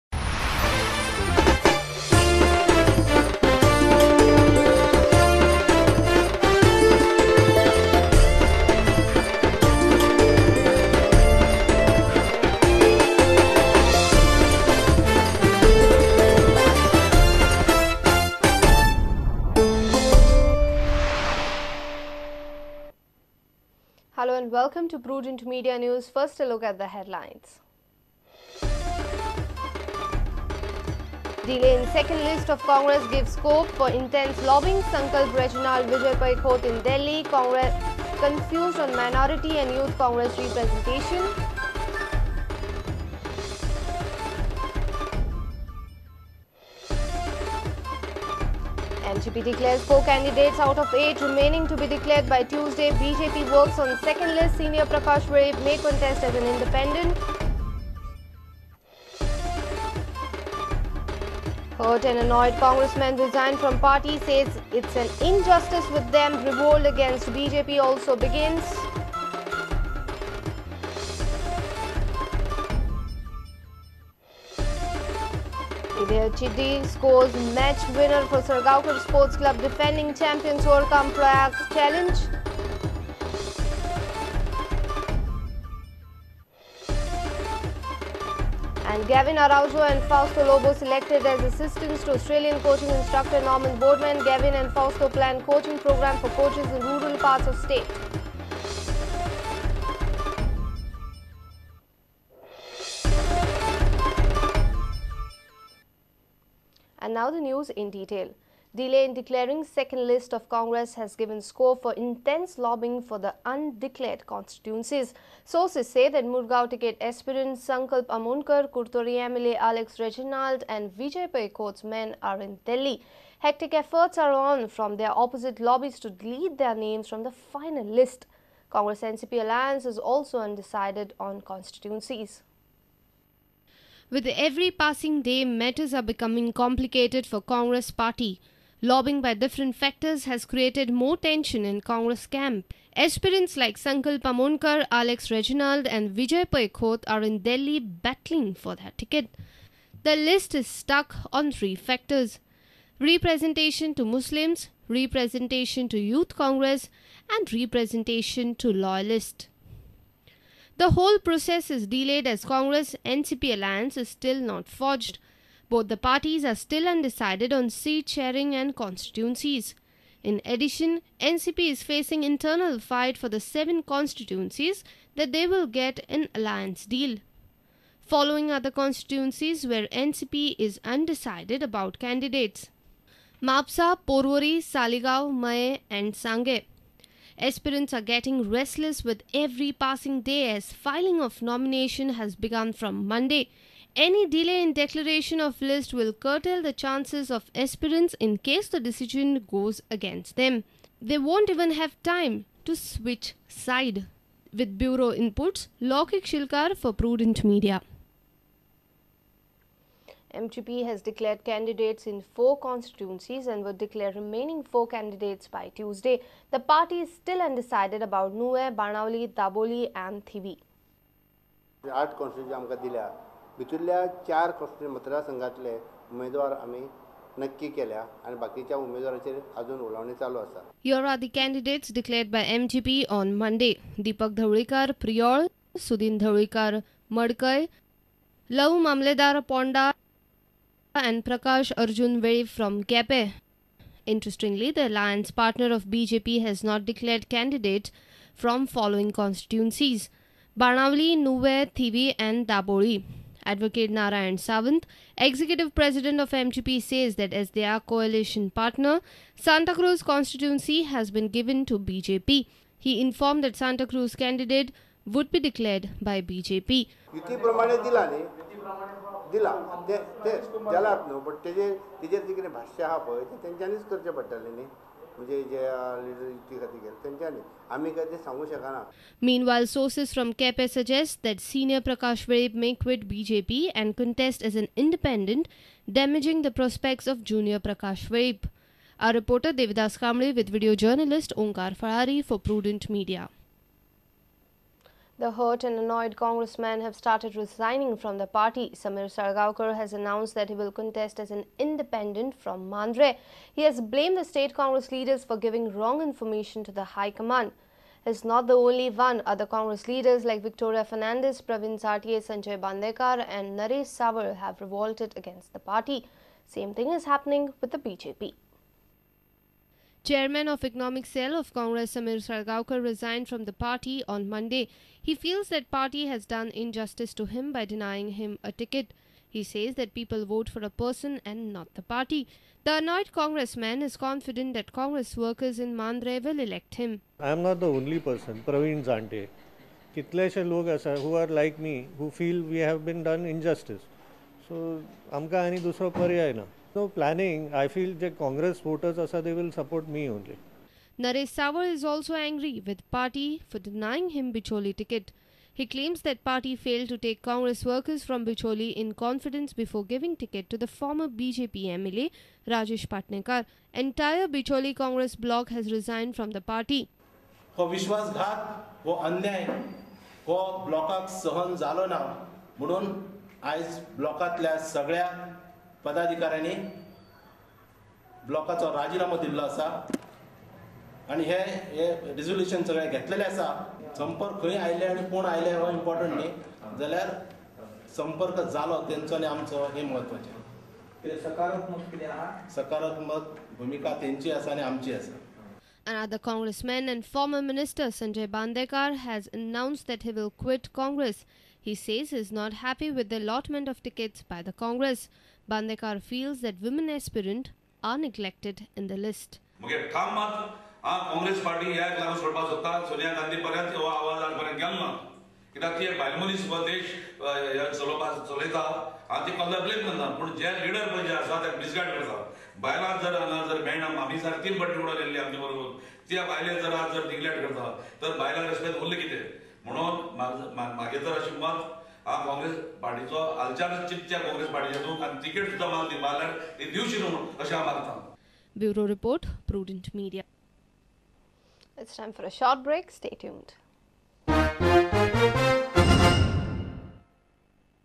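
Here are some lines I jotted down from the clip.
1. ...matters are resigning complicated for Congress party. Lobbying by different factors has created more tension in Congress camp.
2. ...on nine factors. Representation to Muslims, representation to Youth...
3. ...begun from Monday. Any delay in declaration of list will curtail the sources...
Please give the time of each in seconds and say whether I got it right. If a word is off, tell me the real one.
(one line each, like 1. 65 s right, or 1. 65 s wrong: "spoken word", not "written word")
1. 135 s wrong: "becoming", not "resigning"
2. 151 s wrong: "three", not "nine"
3. 192 s wrong: "chances", not "sources".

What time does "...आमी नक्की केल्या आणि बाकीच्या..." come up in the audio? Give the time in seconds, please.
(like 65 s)
226 s.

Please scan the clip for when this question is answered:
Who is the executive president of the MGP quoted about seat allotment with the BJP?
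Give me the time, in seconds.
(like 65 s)
253 s.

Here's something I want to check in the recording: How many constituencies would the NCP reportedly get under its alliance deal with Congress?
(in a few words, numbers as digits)
7.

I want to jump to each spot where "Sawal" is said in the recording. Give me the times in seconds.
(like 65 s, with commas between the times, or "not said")
313 s, 351 s.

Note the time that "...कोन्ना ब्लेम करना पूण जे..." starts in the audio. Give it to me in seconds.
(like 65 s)
419 s.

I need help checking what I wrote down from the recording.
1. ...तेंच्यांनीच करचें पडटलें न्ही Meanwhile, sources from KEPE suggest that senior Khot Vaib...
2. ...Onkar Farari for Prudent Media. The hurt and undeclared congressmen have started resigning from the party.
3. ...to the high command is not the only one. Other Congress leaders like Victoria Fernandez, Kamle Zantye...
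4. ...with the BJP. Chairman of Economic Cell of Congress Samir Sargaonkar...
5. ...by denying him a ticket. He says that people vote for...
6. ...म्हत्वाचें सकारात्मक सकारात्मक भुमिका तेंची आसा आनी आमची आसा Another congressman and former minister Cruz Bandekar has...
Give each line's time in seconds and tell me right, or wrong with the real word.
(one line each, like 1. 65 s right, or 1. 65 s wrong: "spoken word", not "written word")
1. 273 s wrong: "Prakash", not "Khot"
2. 291 s wrong: "annoyed", not "undeclared"
3. 306 s wrong: "Pravin", not "Kamle"
4. 317 s right
5. 327 s right
6. 389 s wrong: "Sanjay", not "Cruz".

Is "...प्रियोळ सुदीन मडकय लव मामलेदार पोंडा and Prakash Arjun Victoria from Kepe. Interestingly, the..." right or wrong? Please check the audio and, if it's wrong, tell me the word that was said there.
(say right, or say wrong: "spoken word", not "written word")
wrong: "Vave", not "Victoria".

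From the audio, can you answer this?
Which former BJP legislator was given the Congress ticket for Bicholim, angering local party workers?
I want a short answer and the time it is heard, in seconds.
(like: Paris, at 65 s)
Rajesh Patnekar, at 362 s.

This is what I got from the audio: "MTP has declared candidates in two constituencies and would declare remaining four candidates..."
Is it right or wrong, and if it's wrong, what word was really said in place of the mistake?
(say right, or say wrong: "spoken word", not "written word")
wrong: "four", not "two".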